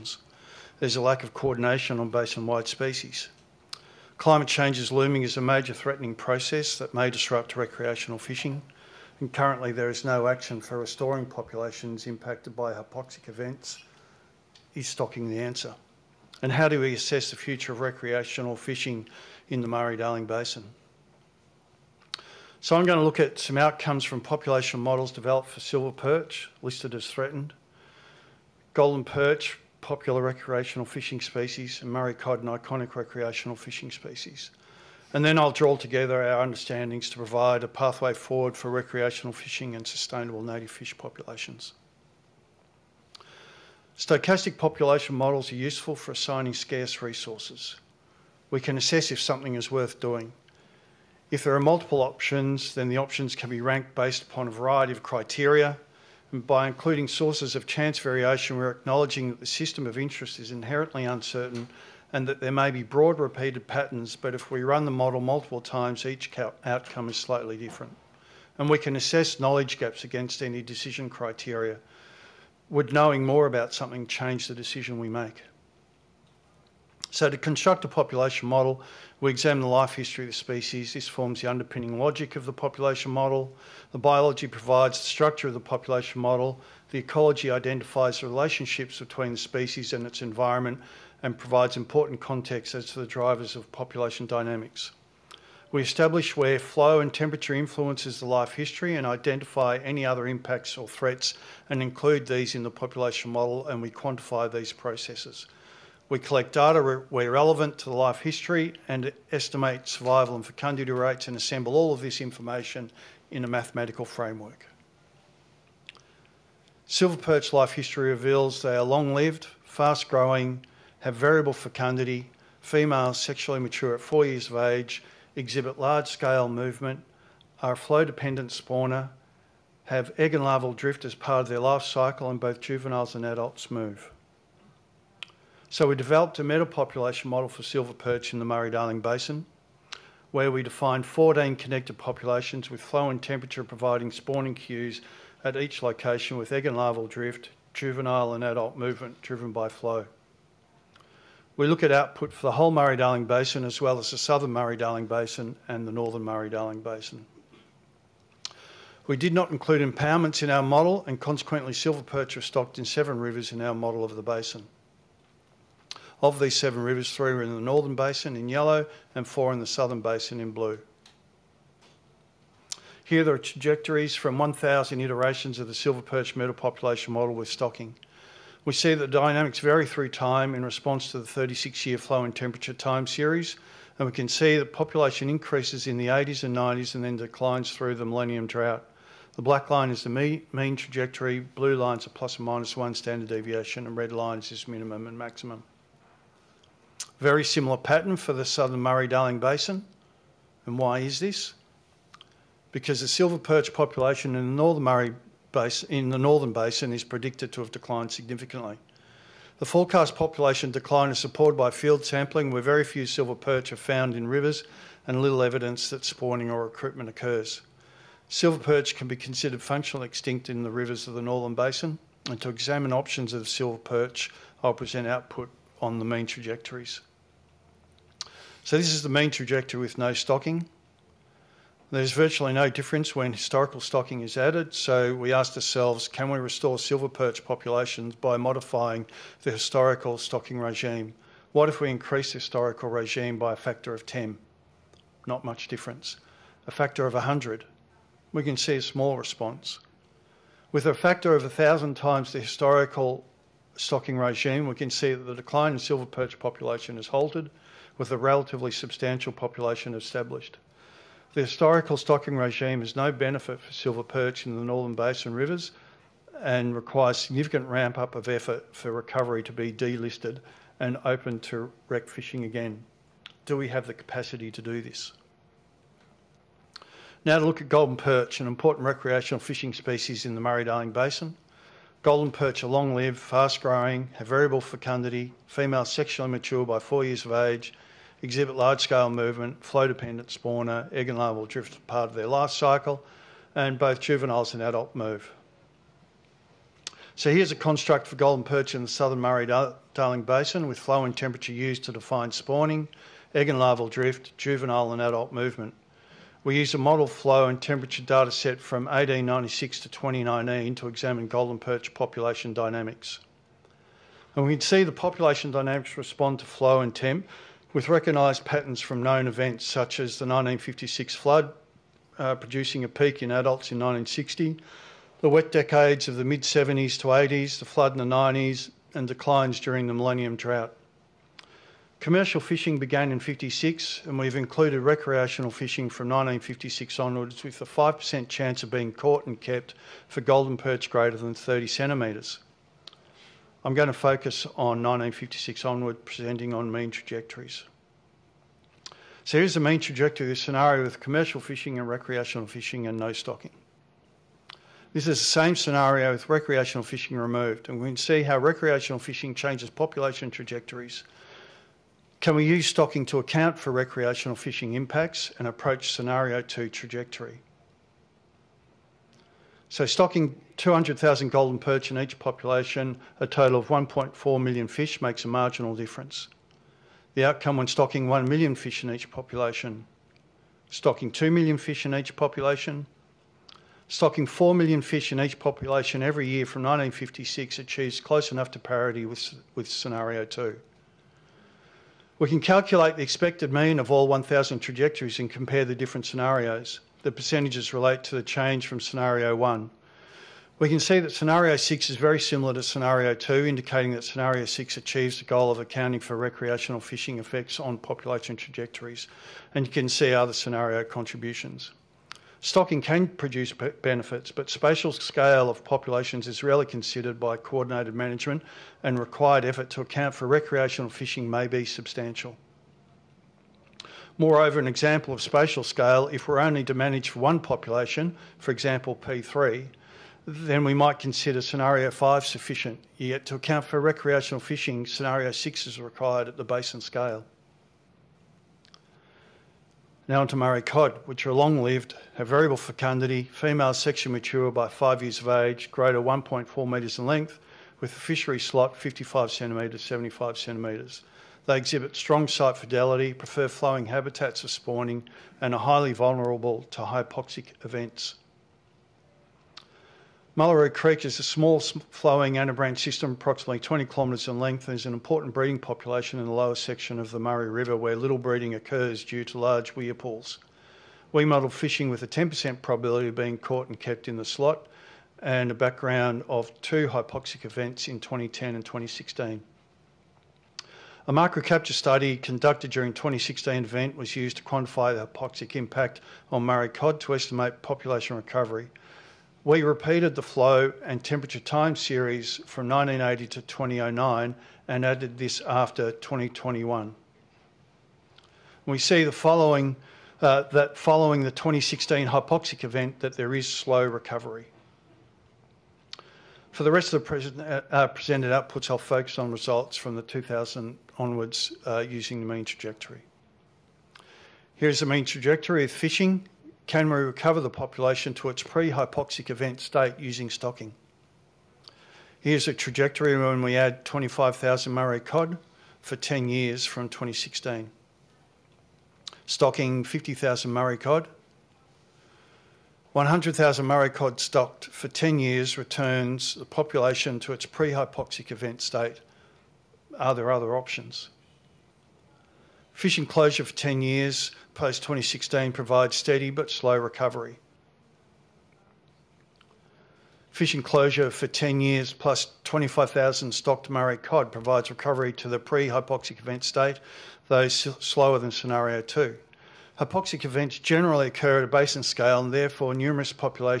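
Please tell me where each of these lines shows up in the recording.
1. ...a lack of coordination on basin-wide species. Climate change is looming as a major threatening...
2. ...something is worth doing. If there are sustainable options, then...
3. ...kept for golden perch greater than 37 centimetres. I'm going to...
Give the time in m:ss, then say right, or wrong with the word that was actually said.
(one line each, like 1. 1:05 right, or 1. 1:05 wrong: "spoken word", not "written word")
1. 0:00 right
2. 0:49 wrong: "multiple", not "sustainable"
3. 5:39 wrong: "30", not "37".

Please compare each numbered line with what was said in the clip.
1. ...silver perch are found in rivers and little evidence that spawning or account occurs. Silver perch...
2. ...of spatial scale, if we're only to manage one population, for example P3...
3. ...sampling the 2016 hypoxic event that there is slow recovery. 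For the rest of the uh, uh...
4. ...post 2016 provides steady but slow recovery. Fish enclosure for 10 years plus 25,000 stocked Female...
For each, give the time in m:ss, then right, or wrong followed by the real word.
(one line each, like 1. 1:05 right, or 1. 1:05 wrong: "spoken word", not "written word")
1. 3:33 wrong: "recruitment", not "account"
2. 7:05 right
3. 8:20 wrong: "following", not "sampling"
4. 9:04 wrong: "Murray", not "Female".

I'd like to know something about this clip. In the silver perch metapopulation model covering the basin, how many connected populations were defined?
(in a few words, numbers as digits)
14.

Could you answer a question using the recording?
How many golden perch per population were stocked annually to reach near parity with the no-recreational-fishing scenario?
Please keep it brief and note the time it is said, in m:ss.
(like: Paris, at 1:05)
4 million, at 6:24.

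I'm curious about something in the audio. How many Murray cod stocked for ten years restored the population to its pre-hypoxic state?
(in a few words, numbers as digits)
100,000.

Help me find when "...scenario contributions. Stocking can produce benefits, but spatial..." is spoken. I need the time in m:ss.
6:50.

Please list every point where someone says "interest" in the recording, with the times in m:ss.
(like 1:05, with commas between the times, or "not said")
0:59.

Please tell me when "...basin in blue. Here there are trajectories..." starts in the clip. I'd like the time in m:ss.
2:49.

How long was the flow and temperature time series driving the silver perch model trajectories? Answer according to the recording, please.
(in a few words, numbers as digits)
36 years.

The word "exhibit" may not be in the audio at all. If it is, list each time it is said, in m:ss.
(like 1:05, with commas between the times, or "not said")
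2:05, 4:48, 7:31.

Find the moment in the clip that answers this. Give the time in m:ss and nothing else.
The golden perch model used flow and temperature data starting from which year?
5:08.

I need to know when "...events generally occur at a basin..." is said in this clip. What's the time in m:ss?
9:20.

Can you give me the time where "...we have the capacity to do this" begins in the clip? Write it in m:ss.
4:33.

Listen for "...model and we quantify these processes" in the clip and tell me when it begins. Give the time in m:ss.
1:43.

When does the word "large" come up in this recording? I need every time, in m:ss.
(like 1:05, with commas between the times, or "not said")
2:05, 4:48, 7:49.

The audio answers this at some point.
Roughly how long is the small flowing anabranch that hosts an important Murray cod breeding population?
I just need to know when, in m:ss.
7:43.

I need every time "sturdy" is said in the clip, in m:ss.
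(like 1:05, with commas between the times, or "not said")
not said.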